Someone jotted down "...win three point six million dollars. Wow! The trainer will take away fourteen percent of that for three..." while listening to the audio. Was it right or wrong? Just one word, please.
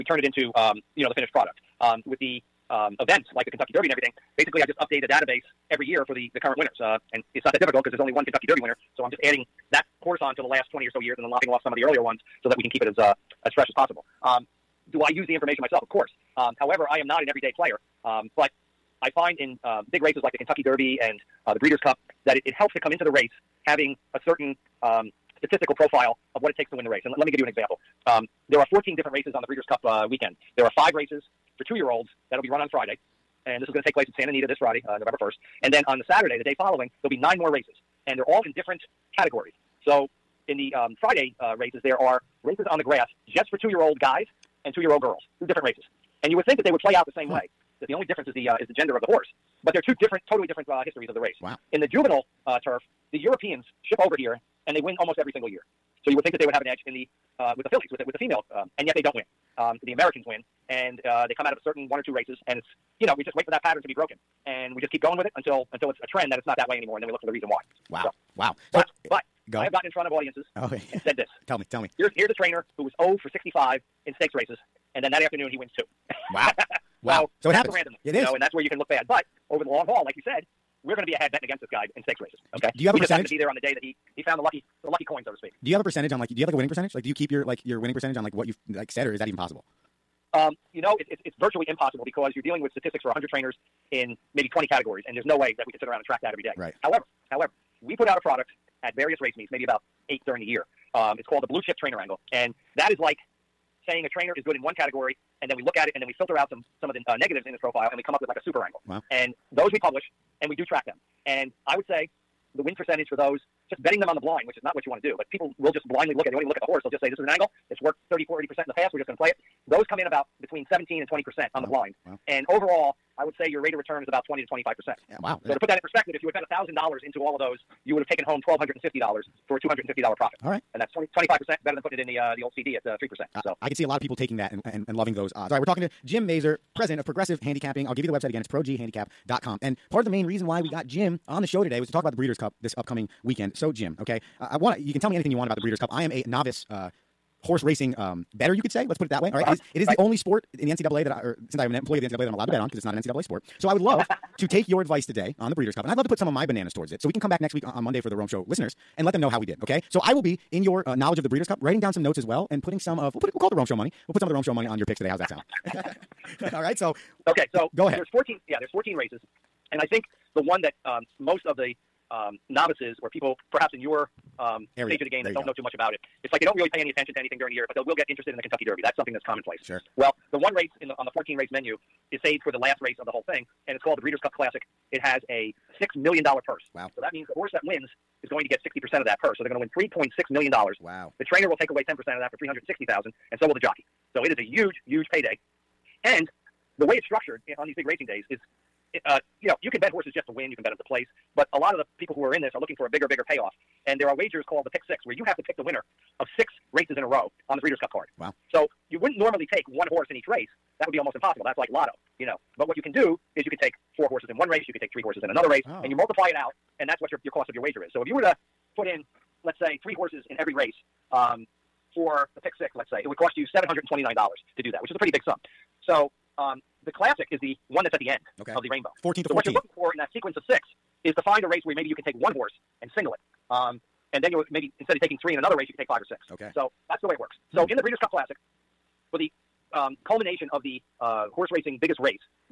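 wrong.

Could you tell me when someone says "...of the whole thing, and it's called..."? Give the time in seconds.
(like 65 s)
183 s.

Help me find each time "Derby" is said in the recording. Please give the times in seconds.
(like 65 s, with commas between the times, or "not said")
3 s, 8 s, 20 s, 178 s.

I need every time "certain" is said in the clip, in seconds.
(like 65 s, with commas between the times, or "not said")
24 s, 61 s.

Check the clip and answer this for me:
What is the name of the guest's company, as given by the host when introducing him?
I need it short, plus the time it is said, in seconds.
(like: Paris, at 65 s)
Progressive Handicapping, at 137 s.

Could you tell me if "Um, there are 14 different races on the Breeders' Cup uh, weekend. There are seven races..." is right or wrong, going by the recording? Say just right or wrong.
wrong.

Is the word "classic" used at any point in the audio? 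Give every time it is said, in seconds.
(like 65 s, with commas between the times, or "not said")
184 s, 226 s, 238 s.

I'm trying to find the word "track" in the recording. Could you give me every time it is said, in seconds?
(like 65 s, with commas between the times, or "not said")
96 s, 110 s.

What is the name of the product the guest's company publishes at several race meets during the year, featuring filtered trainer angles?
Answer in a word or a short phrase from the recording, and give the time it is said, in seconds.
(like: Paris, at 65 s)
Blue Chip Trainer Angle, at 101 s.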